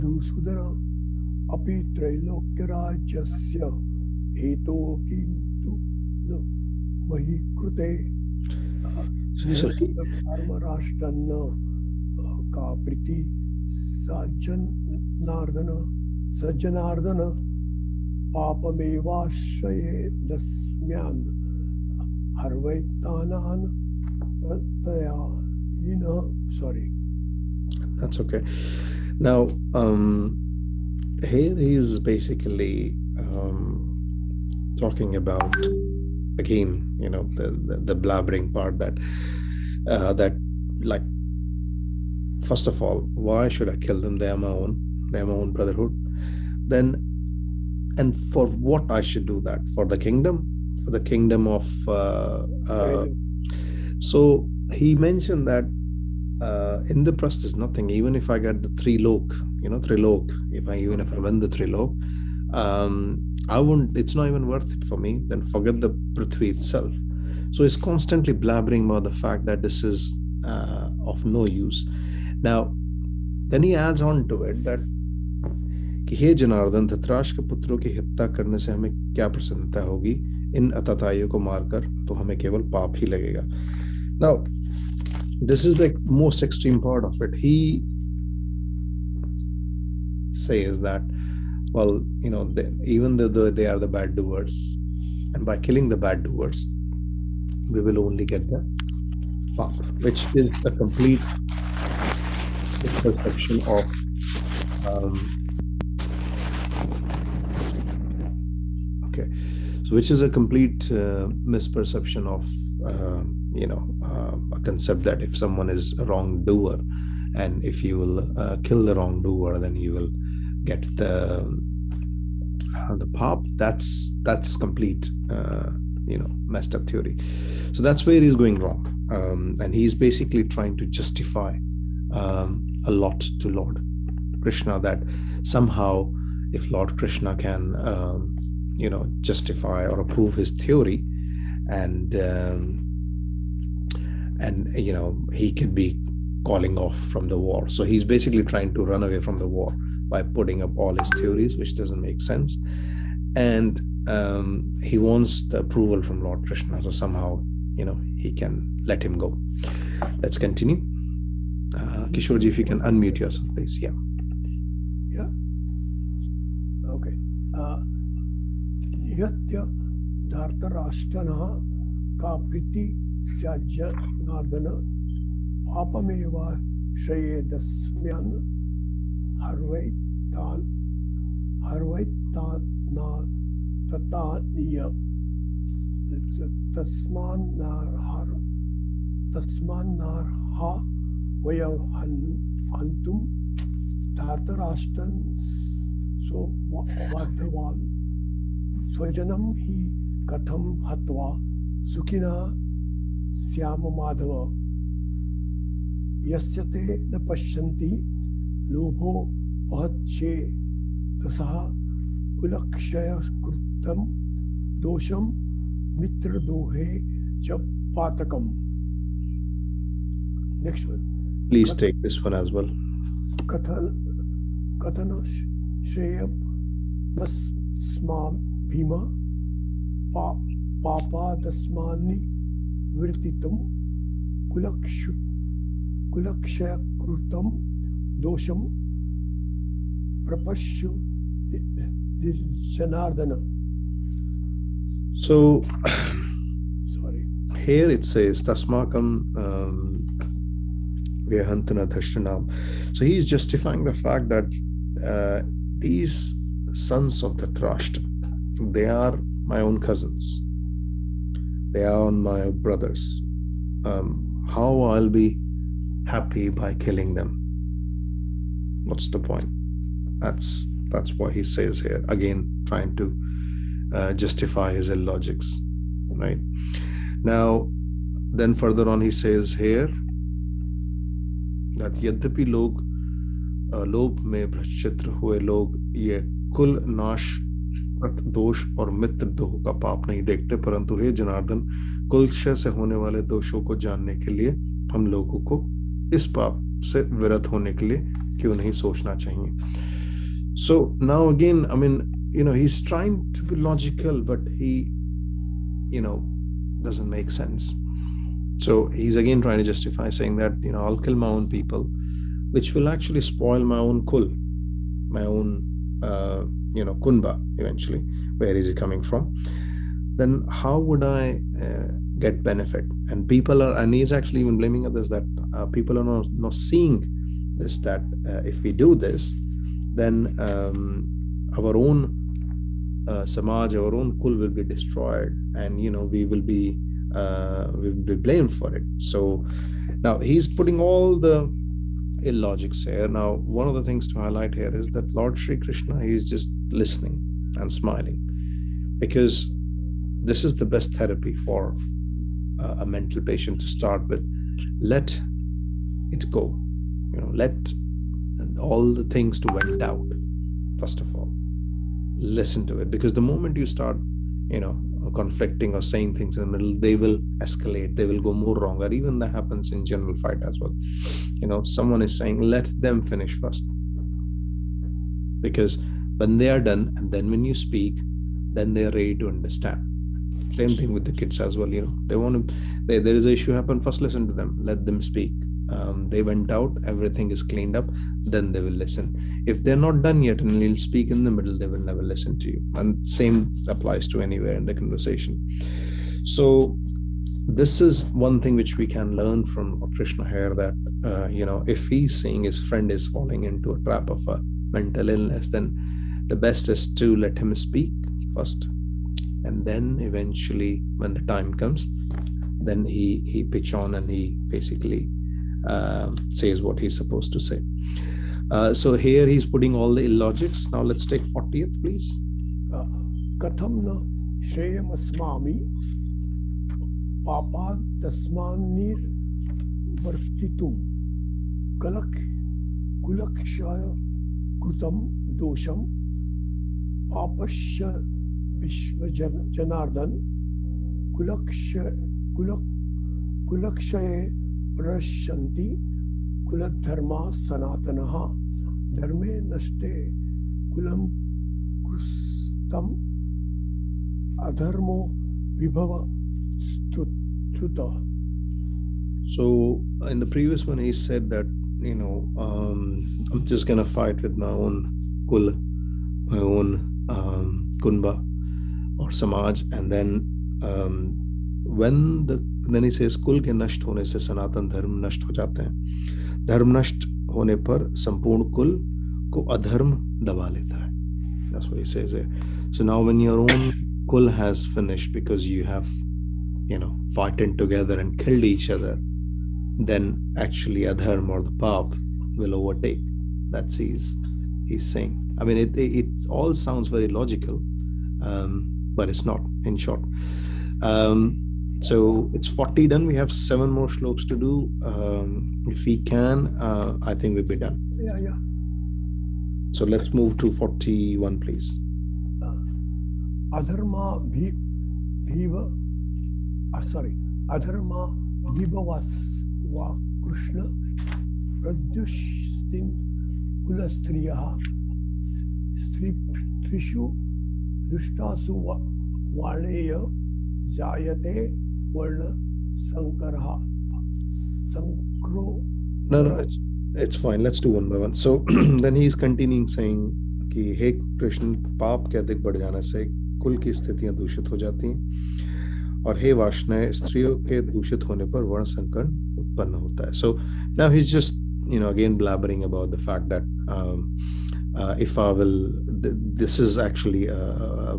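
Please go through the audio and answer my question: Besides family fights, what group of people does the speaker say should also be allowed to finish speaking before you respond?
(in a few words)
kids.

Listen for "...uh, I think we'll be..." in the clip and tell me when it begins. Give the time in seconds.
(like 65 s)
506 s.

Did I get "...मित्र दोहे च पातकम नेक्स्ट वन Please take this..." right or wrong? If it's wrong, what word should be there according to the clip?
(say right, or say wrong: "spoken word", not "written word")
right.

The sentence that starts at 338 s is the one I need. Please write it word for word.
So now he's putting all the illogics here.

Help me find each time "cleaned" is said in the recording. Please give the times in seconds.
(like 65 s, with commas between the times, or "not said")
387 s.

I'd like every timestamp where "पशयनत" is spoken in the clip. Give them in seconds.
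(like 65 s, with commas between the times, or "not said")
207 s.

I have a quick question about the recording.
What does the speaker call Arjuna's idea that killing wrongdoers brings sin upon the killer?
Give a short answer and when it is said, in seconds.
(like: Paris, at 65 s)
complete misperception, at 100 s.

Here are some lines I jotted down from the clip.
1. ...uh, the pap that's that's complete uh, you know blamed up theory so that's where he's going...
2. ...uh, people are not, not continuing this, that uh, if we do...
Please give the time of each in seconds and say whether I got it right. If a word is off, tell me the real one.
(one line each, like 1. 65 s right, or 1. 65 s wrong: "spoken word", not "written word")
1. 122 s wrong: "messed", not "blamed"
2. 325 s wrong: "seeing", not "continuing".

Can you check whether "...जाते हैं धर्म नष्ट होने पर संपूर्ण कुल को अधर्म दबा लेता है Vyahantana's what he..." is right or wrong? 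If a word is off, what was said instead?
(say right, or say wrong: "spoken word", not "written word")
wrong: "That", not "Vyahantana".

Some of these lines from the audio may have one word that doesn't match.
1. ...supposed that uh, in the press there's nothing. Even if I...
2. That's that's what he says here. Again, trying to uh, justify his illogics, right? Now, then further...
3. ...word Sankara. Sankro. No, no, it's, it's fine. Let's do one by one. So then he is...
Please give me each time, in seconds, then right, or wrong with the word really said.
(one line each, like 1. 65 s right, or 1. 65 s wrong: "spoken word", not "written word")
1. 54 s wrong: "mentioned", not "supposed"
2. 270 s right
3. 531 s right.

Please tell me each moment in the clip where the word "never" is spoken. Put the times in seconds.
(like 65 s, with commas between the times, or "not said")
391 s.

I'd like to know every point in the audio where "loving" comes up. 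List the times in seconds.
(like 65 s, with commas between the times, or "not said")
not said.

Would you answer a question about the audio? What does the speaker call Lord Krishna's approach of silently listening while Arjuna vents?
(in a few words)
best therapy.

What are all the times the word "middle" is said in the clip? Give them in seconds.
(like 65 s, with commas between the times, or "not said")
366 s, 391 s.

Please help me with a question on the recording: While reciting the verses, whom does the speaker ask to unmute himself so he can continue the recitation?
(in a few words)
Kishore.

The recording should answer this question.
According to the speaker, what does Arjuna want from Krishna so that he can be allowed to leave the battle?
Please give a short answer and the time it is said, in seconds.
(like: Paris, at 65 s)
approval, at 155 s.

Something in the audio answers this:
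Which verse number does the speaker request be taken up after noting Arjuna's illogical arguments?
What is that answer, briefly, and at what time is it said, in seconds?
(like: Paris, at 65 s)
40, at 421 s.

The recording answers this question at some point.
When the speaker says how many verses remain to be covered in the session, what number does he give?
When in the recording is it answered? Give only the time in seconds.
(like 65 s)
503 s.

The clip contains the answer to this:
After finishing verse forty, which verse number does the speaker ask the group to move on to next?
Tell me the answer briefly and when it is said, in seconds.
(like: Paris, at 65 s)
41, at 510 s.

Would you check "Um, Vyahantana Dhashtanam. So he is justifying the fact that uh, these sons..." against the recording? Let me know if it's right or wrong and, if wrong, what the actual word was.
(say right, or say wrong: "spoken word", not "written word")
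right.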